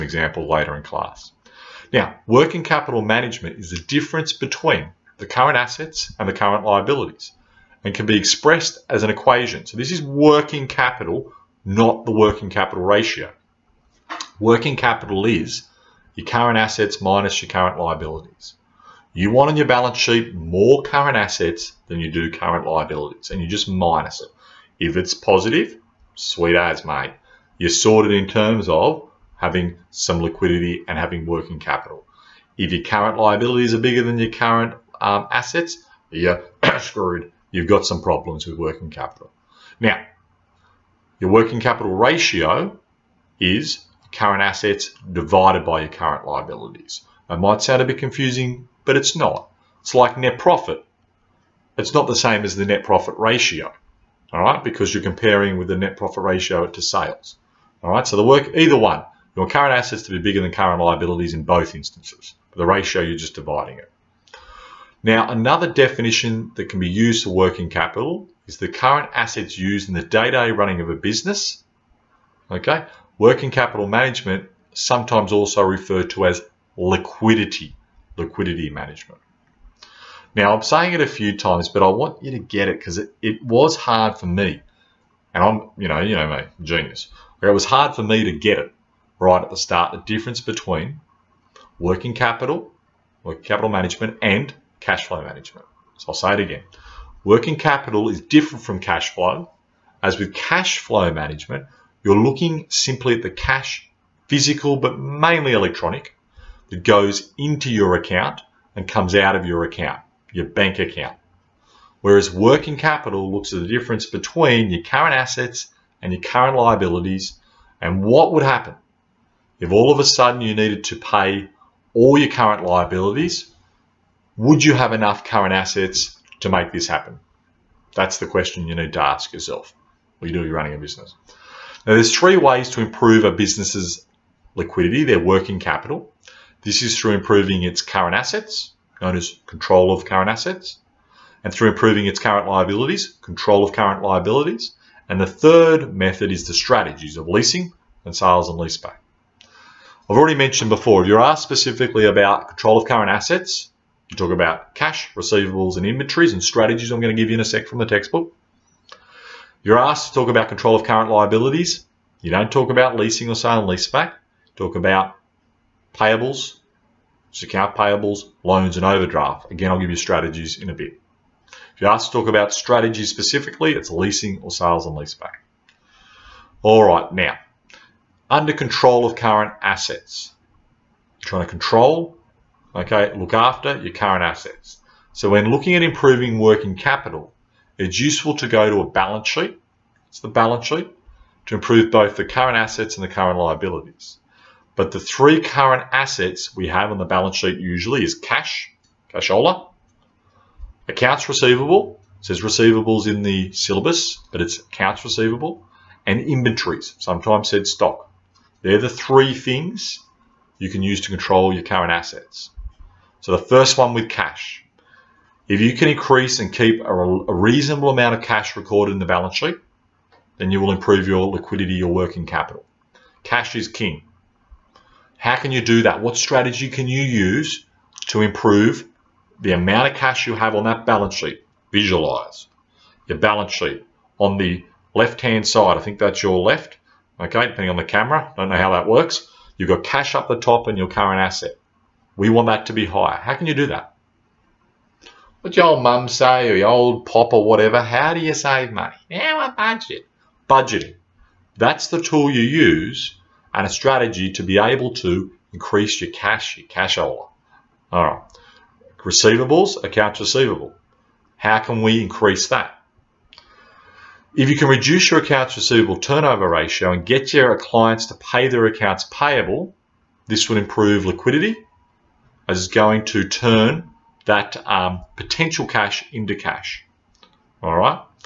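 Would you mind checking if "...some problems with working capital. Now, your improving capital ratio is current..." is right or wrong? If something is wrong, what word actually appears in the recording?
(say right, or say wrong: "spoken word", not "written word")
wrong: "working", not "improving".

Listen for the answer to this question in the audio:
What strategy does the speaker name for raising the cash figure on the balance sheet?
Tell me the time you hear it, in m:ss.
4:10.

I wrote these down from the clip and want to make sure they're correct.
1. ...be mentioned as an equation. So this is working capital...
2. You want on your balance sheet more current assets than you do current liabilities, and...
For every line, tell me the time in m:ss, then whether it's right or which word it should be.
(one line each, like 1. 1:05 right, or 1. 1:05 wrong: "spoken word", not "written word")
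1. 0:08 wrong: "expressed", not "mentioned"
2. 0:19 right.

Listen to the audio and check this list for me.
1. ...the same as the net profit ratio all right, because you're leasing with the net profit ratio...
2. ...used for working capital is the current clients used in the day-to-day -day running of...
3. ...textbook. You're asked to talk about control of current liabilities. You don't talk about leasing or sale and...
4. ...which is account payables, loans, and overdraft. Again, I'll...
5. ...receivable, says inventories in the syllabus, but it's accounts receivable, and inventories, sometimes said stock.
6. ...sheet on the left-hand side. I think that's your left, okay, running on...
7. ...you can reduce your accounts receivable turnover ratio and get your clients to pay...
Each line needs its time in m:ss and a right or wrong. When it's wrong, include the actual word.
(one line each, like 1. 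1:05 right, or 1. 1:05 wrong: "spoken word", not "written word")
1. 0:52 wrong: "comparing", not "leasing"
2. 1:06 wrong: "assets", not "clients"
3. 2:37 right
4. 2:47 right
5. 3:21 wrong: "receivables", not "inventories"
6. 3:53 wrong: "depending", not "running"
7. 4:24 right.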